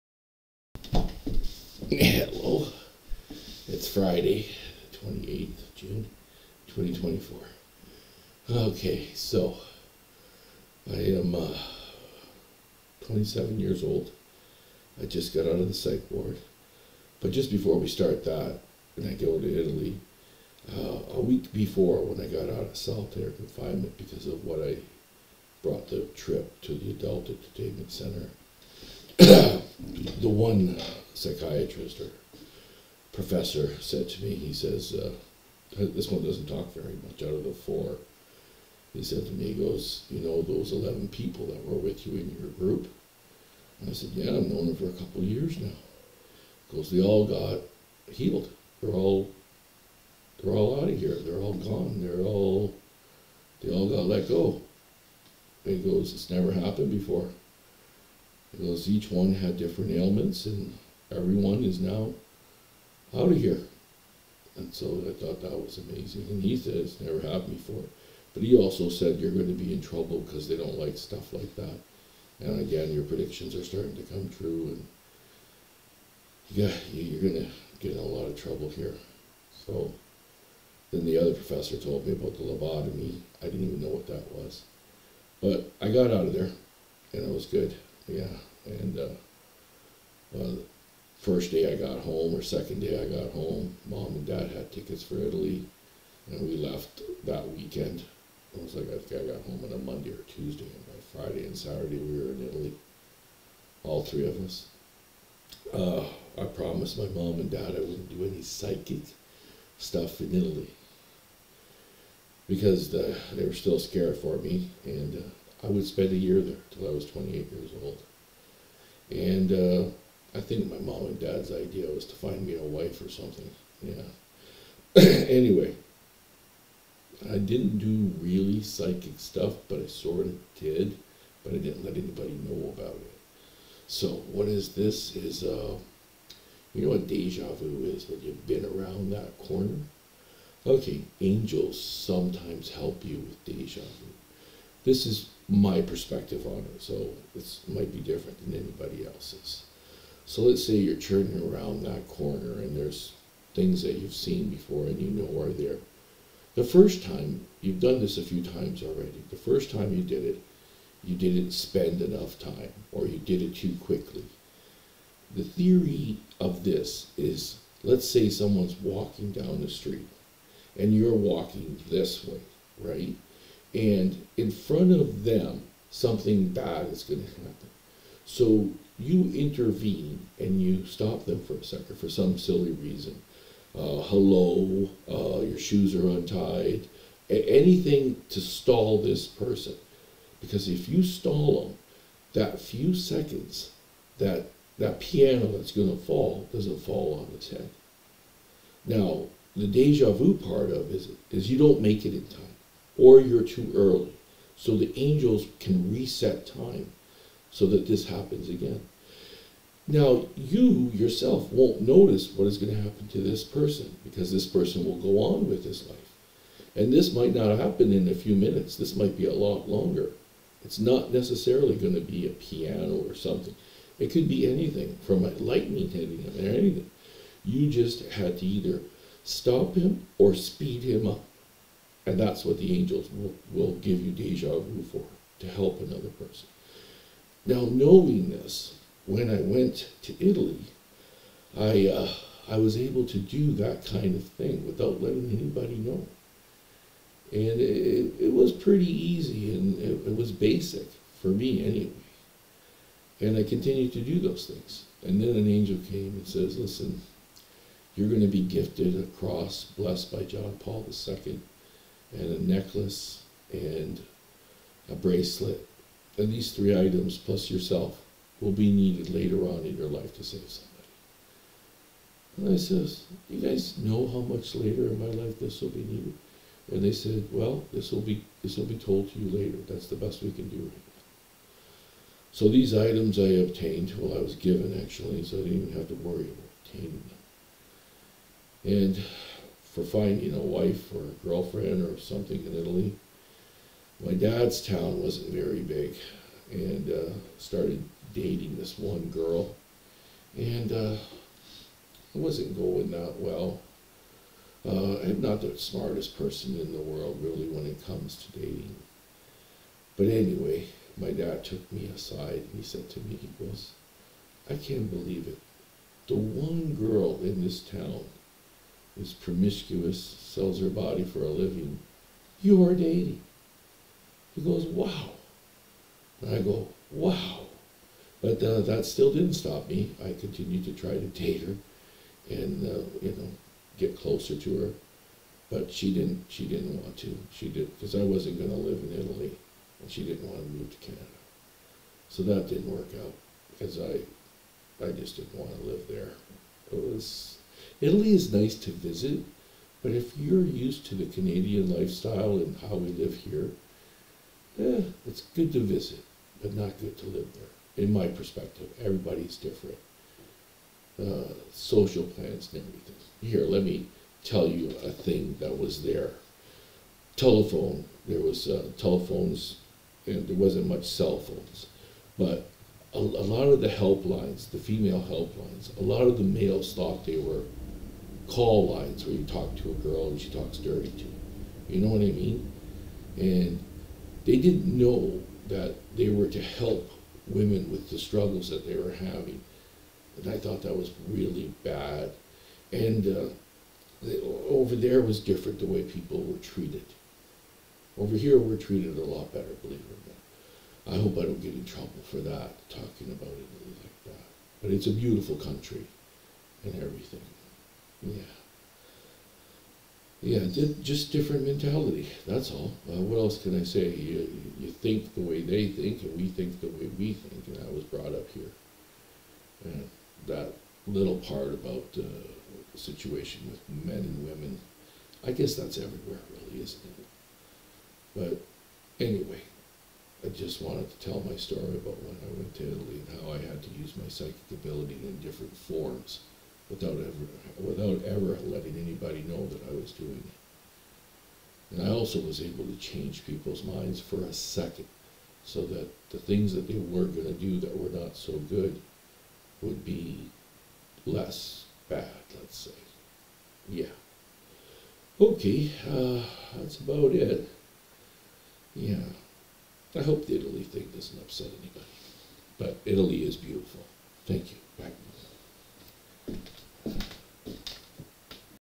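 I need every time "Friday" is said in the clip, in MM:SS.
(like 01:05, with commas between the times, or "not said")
00:03, 01:41.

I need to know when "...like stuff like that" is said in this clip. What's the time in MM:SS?
01:10.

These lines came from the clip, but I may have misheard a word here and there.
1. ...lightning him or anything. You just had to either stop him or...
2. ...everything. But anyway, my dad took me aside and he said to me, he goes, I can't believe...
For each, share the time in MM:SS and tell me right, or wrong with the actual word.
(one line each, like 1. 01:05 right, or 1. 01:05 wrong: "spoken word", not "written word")
1. 03:45 wrong: "hitting", not "lightning"
2. 05:08 wrong: "dating", not "everything".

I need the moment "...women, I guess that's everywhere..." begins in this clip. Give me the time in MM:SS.
07:04.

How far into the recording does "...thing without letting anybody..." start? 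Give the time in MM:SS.
04:04.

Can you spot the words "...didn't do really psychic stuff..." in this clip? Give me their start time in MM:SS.
02:07.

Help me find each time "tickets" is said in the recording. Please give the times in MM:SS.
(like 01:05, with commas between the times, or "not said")
01:34.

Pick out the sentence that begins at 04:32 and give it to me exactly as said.
And I says, you guys know how much later in my life this will be needed?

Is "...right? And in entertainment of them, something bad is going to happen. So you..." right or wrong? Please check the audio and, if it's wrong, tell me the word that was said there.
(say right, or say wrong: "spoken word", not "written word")
wrong: "front", not "entertainment".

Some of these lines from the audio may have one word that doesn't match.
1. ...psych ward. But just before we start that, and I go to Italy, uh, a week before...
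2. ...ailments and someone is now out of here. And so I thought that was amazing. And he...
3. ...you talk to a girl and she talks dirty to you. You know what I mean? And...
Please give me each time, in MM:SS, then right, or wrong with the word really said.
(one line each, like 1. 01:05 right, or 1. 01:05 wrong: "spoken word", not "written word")
1. 00:15 right
2. 00:59 wrong: "everyone", not "someone"
3. 06:19 right.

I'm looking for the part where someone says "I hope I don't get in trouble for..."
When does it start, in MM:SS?
06:40.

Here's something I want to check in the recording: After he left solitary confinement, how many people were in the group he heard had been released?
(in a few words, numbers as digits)
11.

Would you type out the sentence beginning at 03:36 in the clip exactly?
And this might not happen in a few minutes, this might be a lot longer.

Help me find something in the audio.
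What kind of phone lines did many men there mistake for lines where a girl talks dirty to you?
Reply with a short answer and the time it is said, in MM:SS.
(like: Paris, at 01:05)
Female helplines, at 06:14.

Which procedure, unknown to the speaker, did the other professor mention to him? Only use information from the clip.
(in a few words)
Lobotomy.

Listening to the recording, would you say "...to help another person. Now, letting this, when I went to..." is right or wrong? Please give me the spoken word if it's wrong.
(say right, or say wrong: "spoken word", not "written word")
wrong: "knowing", not "letting".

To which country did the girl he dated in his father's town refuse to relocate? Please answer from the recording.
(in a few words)
Canada.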